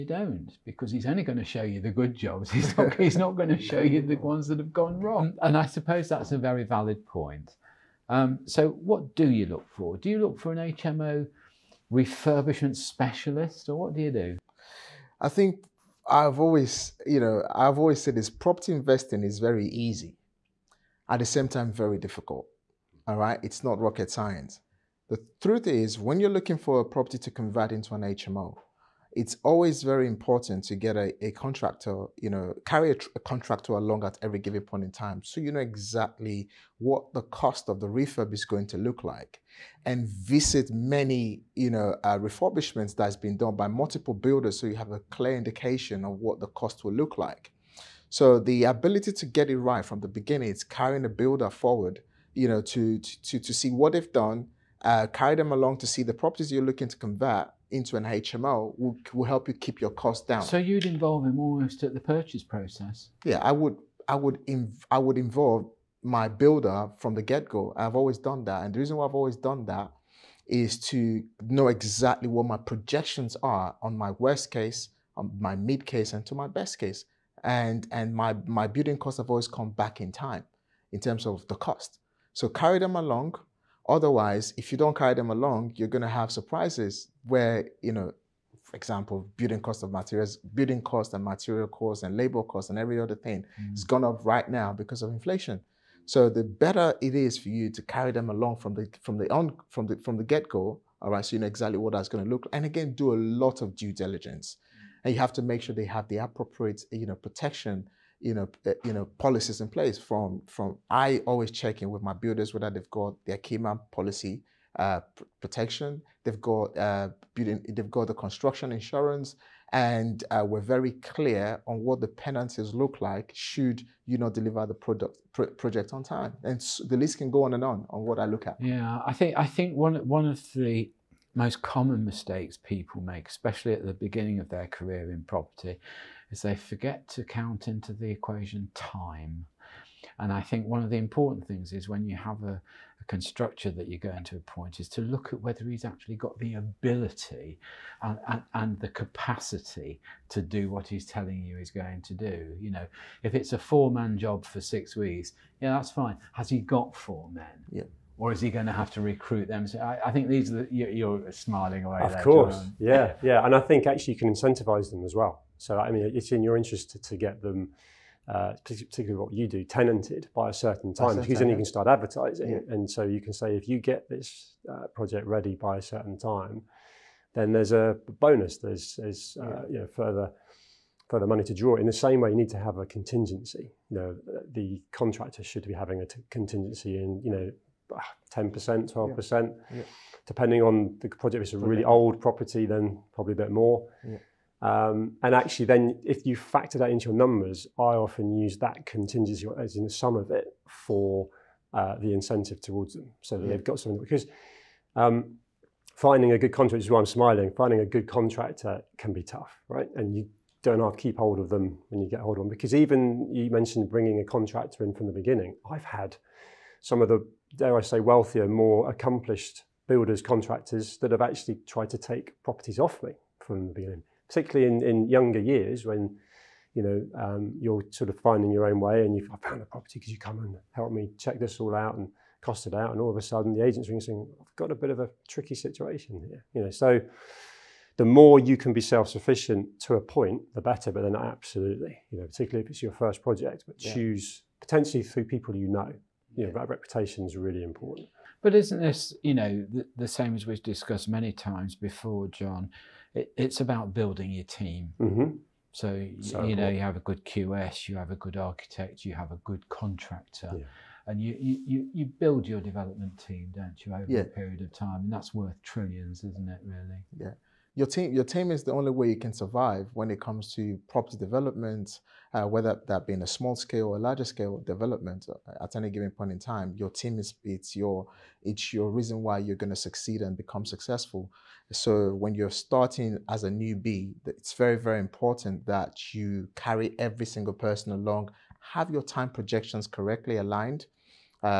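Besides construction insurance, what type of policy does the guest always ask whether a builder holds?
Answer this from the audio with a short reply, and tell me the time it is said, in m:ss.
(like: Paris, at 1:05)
key man policy, at 1:53.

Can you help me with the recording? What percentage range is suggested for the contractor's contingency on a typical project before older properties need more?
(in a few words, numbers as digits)
10 to 12 percent.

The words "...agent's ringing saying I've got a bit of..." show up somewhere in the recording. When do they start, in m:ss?
3:53.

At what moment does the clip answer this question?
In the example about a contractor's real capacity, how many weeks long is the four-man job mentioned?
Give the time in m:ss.
2:34.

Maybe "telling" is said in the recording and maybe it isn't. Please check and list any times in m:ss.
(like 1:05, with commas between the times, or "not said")
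2:31.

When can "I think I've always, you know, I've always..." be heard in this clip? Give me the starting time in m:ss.
0:15.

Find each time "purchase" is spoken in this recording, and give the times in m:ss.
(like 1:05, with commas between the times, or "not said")
1:01.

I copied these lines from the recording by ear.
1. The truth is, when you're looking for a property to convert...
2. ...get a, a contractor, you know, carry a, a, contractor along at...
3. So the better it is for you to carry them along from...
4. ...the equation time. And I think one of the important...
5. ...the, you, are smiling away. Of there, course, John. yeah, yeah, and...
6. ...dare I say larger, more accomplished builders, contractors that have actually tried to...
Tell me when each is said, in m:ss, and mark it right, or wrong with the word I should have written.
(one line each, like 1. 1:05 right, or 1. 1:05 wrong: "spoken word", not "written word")
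1. 0:25 right
2. 0:30 right
3. 1:36 right
4. 2:17 right
5. 2:40 right
6. 3:37 wrong: "wealthier", not "larger".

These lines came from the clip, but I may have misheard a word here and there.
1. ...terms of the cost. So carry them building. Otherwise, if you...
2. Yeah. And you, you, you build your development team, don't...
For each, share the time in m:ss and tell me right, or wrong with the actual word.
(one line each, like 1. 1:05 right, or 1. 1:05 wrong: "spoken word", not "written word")
1. 1:20 wrong: "along", not "building"
2. 4:20 right.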